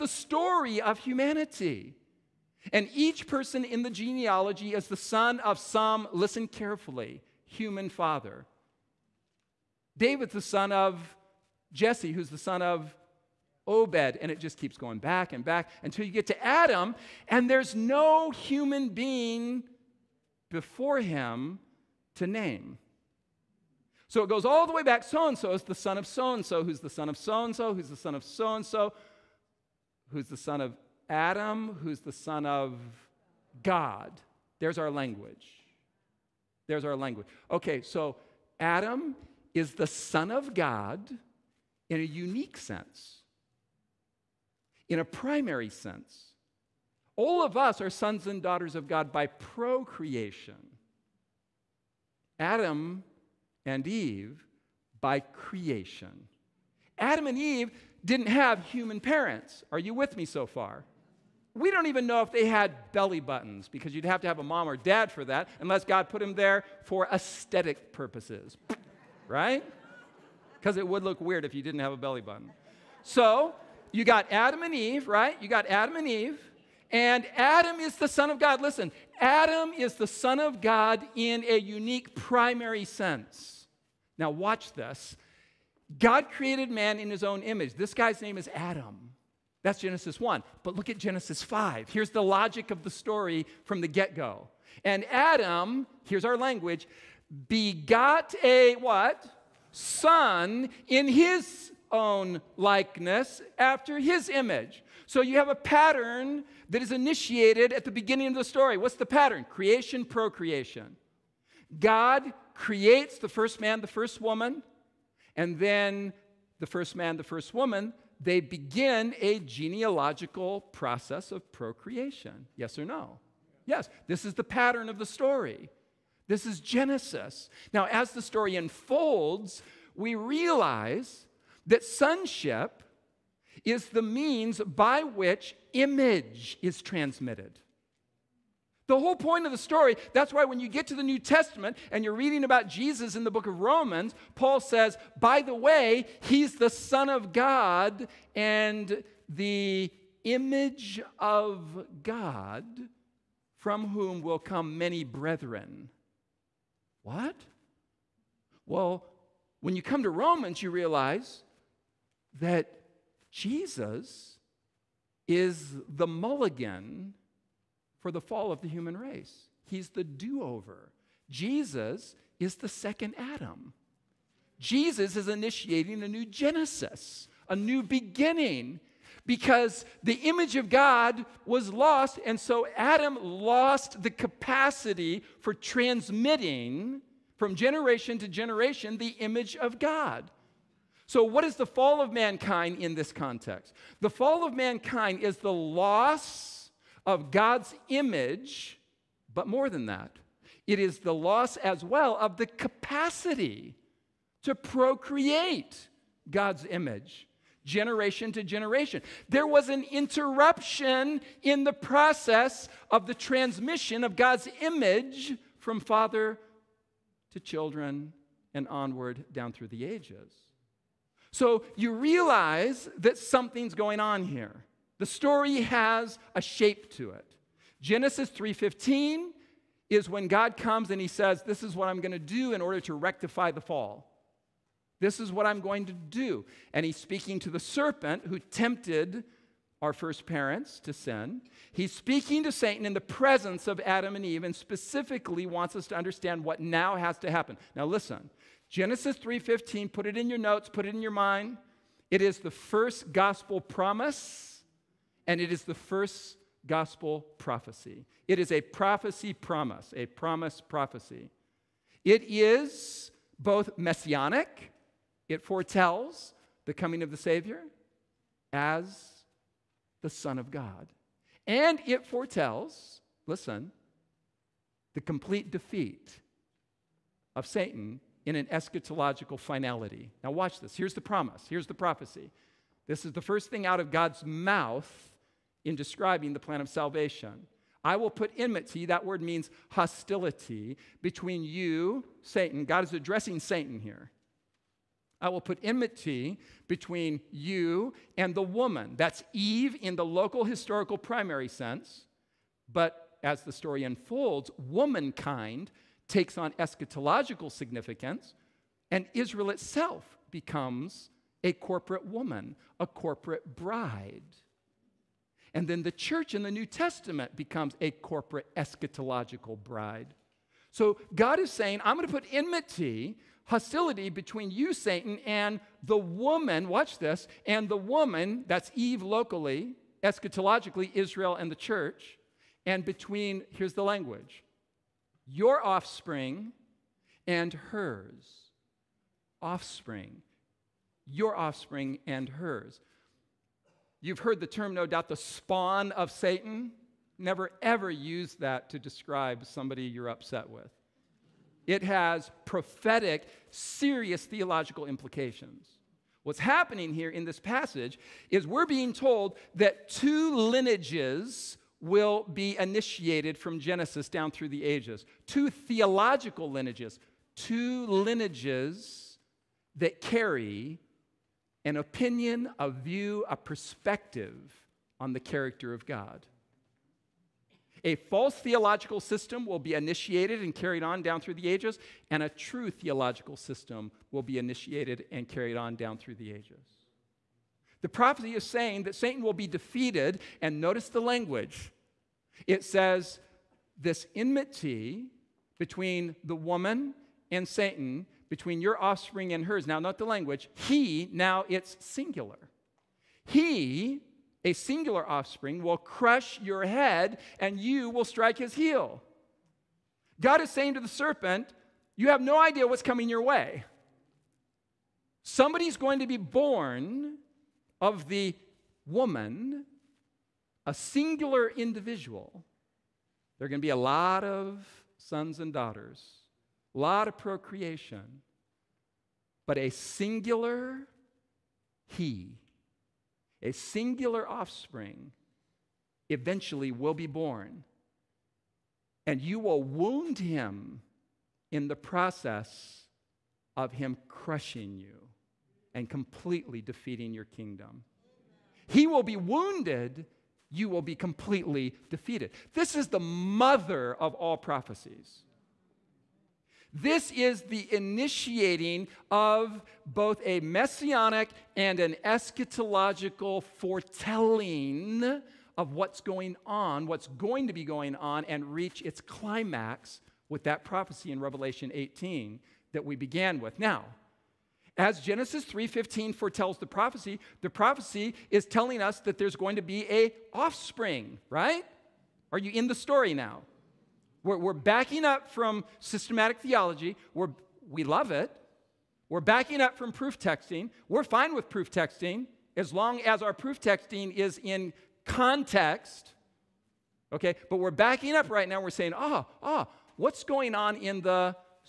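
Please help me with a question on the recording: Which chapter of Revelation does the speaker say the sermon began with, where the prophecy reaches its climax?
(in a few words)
Revelation 18.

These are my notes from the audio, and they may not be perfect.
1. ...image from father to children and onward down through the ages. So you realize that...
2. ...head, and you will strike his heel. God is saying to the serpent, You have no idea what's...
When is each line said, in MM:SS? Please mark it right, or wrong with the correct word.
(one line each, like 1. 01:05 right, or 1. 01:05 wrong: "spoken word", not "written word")
1. 03:34 right
2. 06:46 right.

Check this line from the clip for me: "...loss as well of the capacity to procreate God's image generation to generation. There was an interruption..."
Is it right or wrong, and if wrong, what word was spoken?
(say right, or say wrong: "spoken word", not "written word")
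right.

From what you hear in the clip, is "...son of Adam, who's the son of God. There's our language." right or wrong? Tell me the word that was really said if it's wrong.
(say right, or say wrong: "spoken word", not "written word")
right.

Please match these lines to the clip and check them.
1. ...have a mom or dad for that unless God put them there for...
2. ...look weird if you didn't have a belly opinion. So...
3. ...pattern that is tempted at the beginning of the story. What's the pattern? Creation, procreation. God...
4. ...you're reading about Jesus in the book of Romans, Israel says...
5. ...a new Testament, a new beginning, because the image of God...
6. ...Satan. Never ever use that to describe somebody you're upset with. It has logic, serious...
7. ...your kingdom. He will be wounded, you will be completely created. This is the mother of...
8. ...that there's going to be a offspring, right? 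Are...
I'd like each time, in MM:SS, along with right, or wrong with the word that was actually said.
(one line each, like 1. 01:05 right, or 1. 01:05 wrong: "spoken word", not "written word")
1. 01:04 right
2. 01:11 wrong: "button", not "opinion"
3. 01:45 wrong: "initiated", not "tempted"
4. 02:22 wrong: "Paul", not "Israel"
5. 02:56 wrong: "Genesis", not "Testament"
6. 05:46 wrong: "prophetic", not "logic"
7. 07:27 wrong: "defeated", not "created"
8. 07:59 right.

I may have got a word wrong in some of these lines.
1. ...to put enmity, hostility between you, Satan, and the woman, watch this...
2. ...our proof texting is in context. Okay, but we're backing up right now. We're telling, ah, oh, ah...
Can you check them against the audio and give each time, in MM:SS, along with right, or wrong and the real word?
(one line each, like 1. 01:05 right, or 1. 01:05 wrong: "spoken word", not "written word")
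1. 05:22 right
2. 08:13 wrong: "saying", not "telling".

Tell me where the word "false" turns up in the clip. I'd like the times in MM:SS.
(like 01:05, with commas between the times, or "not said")
06:17.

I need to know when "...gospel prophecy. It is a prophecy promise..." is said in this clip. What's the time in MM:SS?
04:16.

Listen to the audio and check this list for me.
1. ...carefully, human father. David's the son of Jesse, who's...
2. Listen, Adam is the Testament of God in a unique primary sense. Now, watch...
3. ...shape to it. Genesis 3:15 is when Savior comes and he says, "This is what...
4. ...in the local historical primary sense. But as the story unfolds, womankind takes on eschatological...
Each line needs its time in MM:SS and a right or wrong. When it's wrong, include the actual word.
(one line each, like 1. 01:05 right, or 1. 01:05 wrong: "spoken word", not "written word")
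1. 00:06 right
2. 01:18 wrong: "Son", not "Testament"
3. 03:46 wrong: "God", not "Savior"
4. 04:59 right.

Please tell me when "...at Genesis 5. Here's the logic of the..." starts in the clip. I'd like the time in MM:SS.
01:30.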